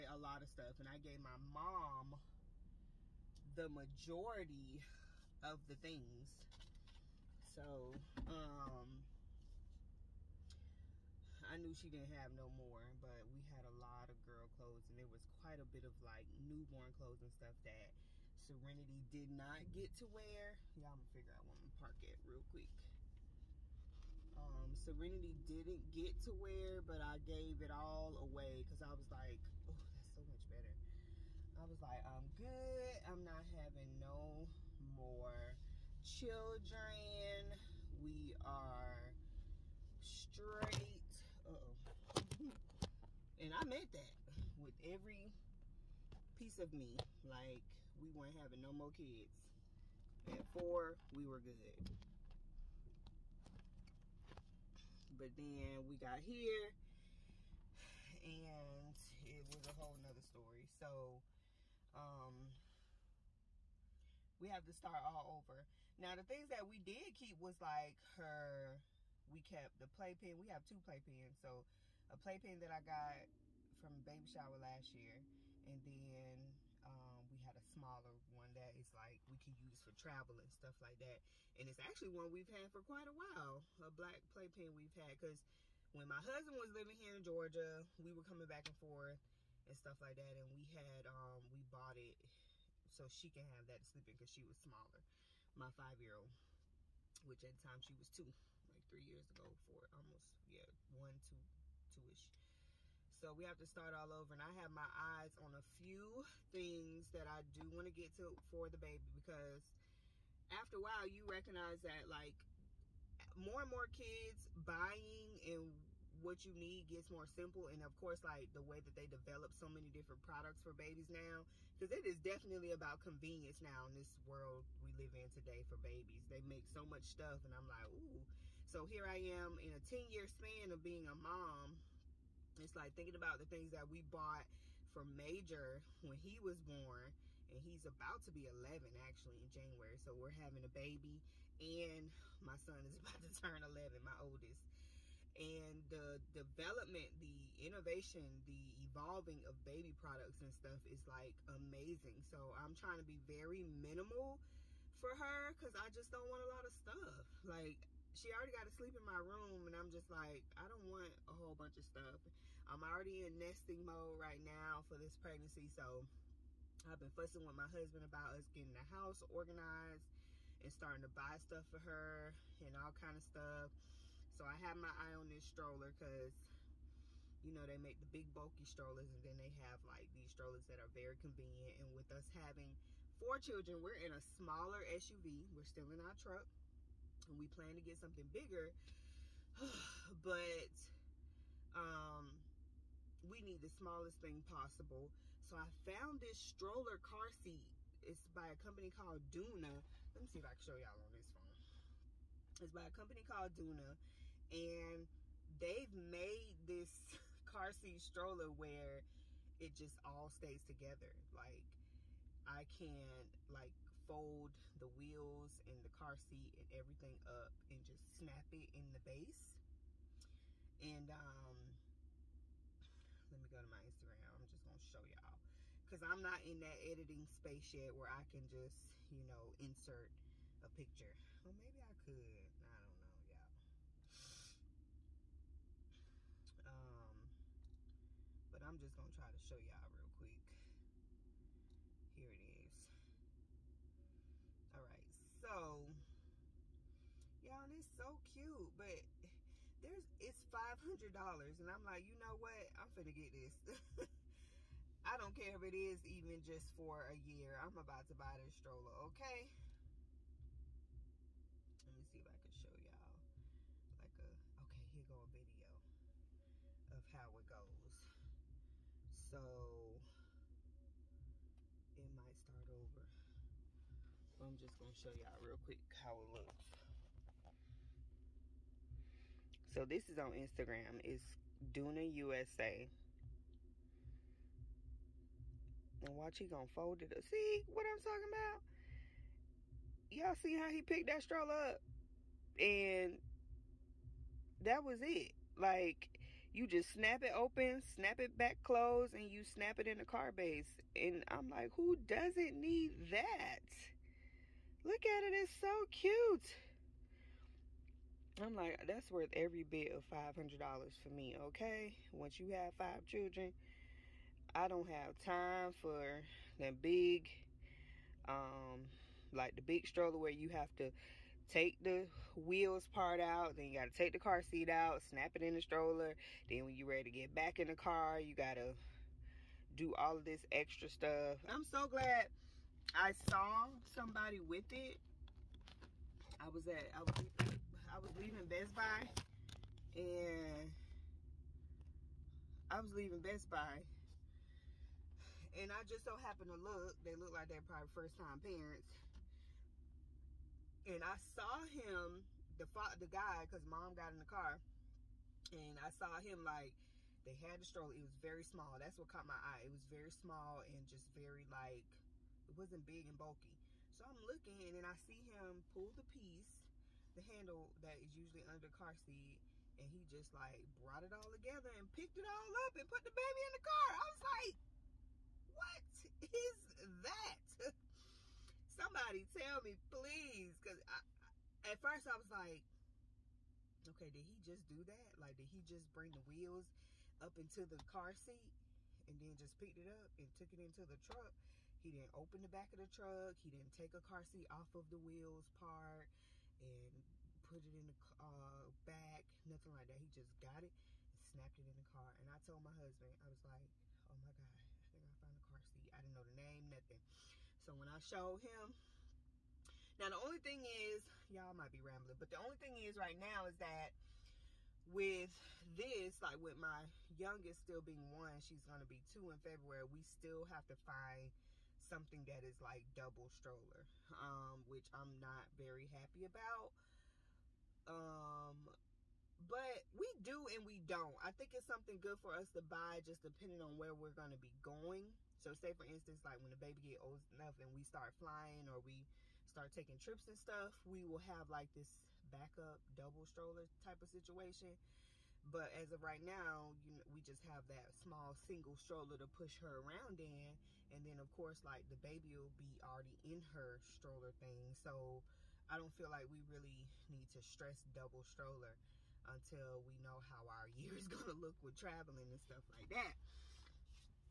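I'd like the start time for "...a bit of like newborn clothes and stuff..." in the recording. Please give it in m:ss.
0:15.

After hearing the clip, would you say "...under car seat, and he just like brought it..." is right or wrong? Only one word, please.
right.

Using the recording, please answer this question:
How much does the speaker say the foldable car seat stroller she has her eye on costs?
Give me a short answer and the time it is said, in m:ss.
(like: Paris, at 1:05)
$500, at 4:10.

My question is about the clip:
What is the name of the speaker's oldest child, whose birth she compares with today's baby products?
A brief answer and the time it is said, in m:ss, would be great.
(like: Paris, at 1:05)
Major, at 2:15.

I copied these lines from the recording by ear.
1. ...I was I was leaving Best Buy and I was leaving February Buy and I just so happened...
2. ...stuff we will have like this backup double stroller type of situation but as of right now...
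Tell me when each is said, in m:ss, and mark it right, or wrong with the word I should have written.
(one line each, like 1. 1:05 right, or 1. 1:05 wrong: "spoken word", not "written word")
1. 5:36 wrong: "Best", not "February"
2. 7:20 right.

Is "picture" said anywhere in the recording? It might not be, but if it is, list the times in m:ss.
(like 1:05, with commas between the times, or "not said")
3:50.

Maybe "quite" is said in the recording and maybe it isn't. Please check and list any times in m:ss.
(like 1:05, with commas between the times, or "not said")
0:15, 1:22.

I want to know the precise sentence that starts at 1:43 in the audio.
So we have to start all over.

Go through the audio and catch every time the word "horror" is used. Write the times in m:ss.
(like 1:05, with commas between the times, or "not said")
not said.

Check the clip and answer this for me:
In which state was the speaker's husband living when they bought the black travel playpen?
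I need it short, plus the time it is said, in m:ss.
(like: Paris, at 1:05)
Georgia, at 1:27.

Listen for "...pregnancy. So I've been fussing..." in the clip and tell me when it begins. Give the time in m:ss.
2:45.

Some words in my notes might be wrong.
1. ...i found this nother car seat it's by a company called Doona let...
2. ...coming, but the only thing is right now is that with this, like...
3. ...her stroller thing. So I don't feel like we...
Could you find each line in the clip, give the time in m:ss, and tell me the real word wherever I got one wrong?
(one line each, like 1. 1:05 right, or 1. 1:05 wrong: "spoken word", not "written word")
1. 3:15 wrong: "stroller", not "nother"
2. 6:51 wrong: "rambling", not "coming"
3. 7:33 right.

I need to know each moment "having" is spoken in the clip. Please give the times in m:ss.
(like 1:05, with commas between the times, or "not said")
0:33, 0:48, 2:20, 3:02.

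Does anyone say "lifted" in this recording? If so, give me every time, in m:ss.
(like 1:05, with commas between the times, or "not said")
not said.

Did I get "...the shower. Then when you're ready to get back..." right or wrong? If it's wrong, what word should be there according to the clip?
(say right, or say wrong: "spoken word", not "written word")
wrong: "stroller", not "shower".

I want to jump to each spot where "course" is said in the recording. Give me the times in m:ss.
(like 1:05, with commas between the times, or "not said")
1:57, 7:31.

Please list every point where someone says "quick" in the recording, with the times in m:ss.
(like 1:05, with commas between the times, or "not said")
0:22, 4:00, 4:35.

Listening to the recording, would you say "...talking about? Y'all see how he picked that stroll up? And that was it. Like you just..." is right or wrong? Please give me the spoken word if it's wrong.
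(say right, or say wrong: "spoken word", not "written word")
right.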